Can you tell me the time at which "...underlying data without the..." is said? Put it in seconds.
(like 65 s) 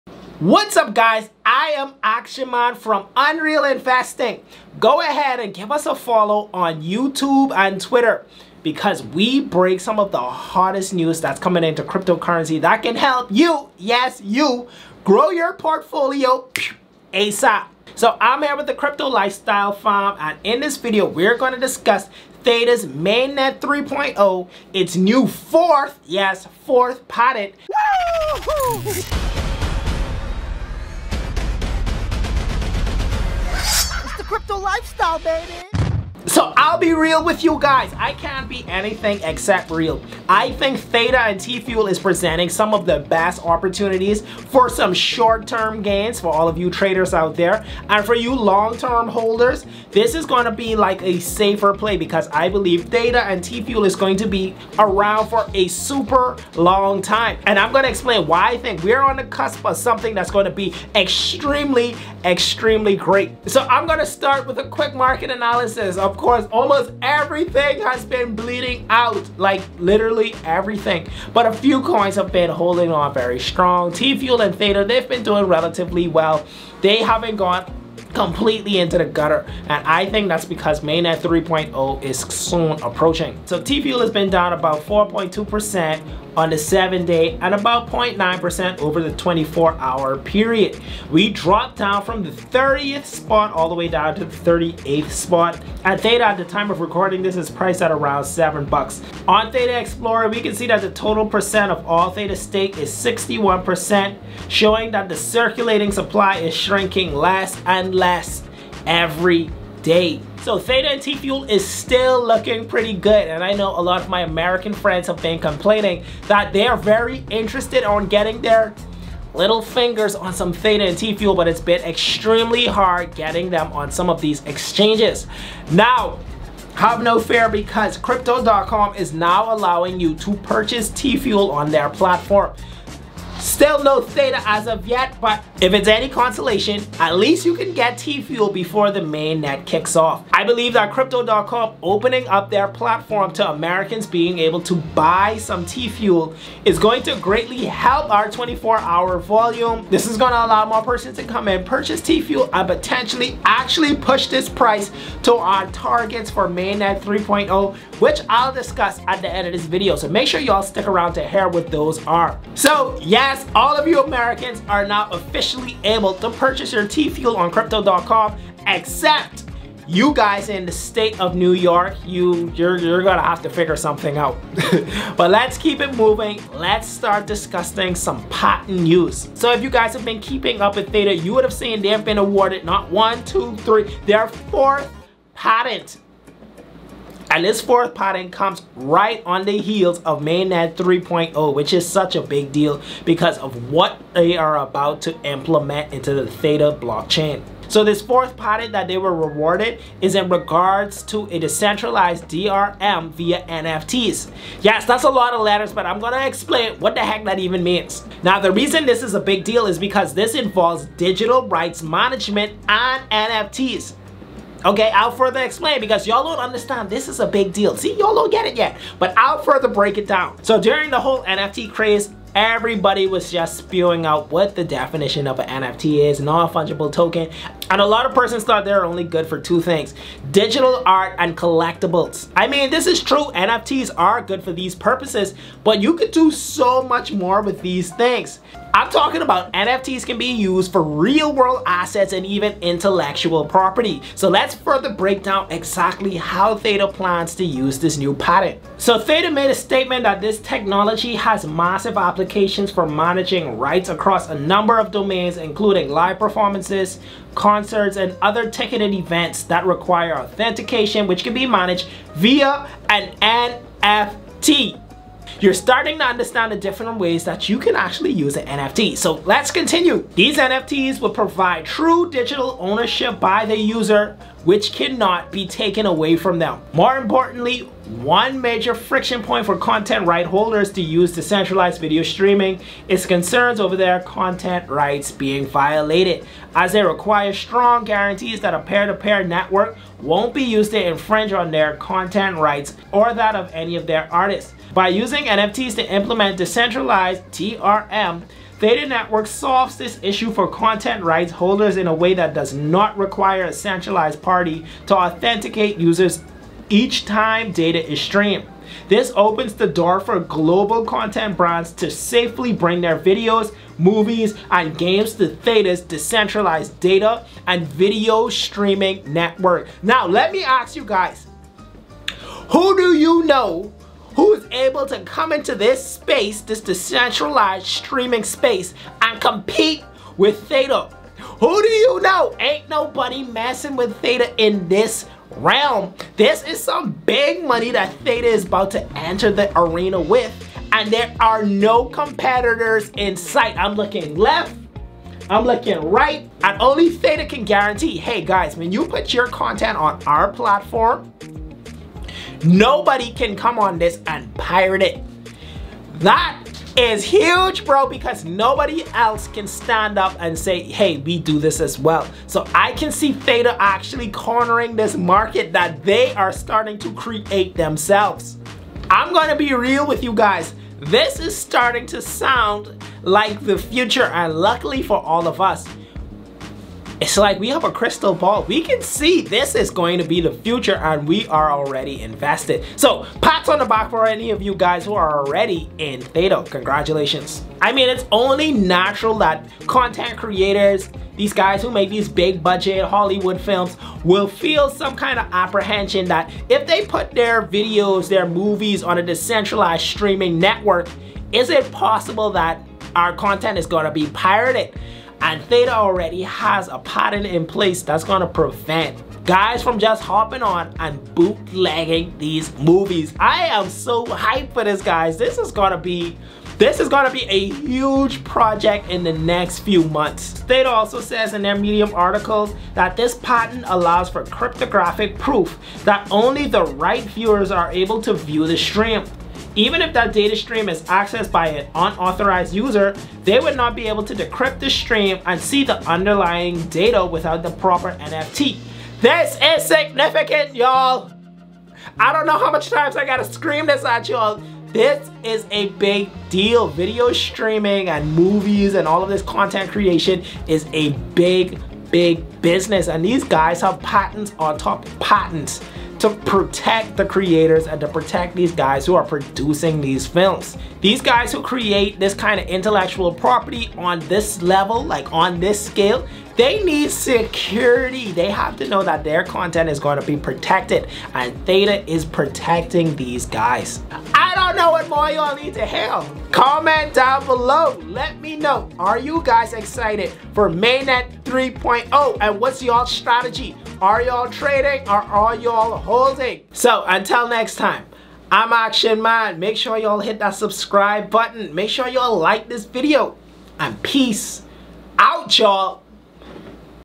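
435 s.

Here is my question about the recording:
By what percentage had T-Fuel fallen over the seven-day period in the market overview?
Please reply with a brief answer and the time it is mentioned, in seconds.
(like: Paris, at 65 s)
4.2%, at 84 s.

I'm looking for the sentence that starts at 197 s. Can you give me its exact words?
So this fourth patent that they were rewarded is in regards to a decentralized DRM via NFTs.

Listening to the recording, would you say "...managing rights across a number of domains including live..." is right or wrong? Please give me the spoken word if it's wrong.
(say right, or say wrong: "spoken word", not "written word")
right.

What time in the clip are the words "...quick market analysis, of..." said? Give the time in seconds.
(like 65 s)
64 s.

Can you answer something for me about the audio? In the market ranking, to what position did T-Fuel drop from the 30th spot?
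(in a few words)
38th.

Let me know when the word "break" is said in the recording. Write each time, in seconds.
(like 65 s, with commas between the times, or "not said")
9 s, 219 s, 244 s.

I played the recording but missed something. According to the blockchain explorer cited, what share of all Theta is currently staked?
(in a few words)
61%.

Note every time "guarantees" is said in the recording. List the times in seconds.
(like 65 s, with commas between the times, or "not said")
287 s, 347 s.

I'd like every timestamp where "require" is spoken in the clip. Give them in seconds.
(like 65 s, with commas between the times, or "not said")
259 s, 286 s, 302 s.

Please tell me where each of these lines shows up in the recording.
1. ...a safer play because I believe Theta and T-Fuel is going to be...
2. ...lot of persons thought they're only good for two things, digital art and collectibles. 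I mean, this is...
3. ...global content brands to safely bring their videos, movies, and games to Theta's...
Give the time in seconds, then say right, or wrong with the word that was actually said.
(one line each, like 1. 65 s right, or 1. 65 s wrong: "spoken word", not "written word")
1. 51 s right
2. 227 s right
3. 310 s right.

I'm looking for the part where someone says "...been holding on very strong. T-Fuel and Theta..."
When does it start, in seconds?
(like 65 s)
72 s.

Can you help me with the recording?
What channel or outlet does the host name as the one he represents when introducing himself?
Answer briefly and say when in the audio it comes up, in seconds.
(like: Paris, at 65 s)
Unreel Investing, at 3 s.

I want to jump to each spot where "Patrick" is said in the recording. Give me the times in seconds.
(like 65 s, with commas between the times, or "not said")
not said.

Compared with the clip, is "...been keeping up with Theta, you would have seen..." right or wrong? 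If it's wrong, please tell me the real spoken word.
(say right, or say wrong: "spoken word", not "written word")
right.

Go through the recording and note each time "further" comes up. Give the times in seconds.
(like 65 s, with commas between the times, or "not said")
215 s, 219 s, 244 s.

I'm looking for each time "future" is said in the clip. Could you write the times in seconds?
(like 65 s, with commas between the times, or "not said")
373 s, 380 s.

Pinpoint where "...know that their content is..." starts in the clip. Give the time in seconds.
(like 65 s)
468 s.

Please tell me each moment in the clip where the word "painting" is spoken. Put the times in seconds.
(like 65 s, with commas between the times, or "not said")
not said.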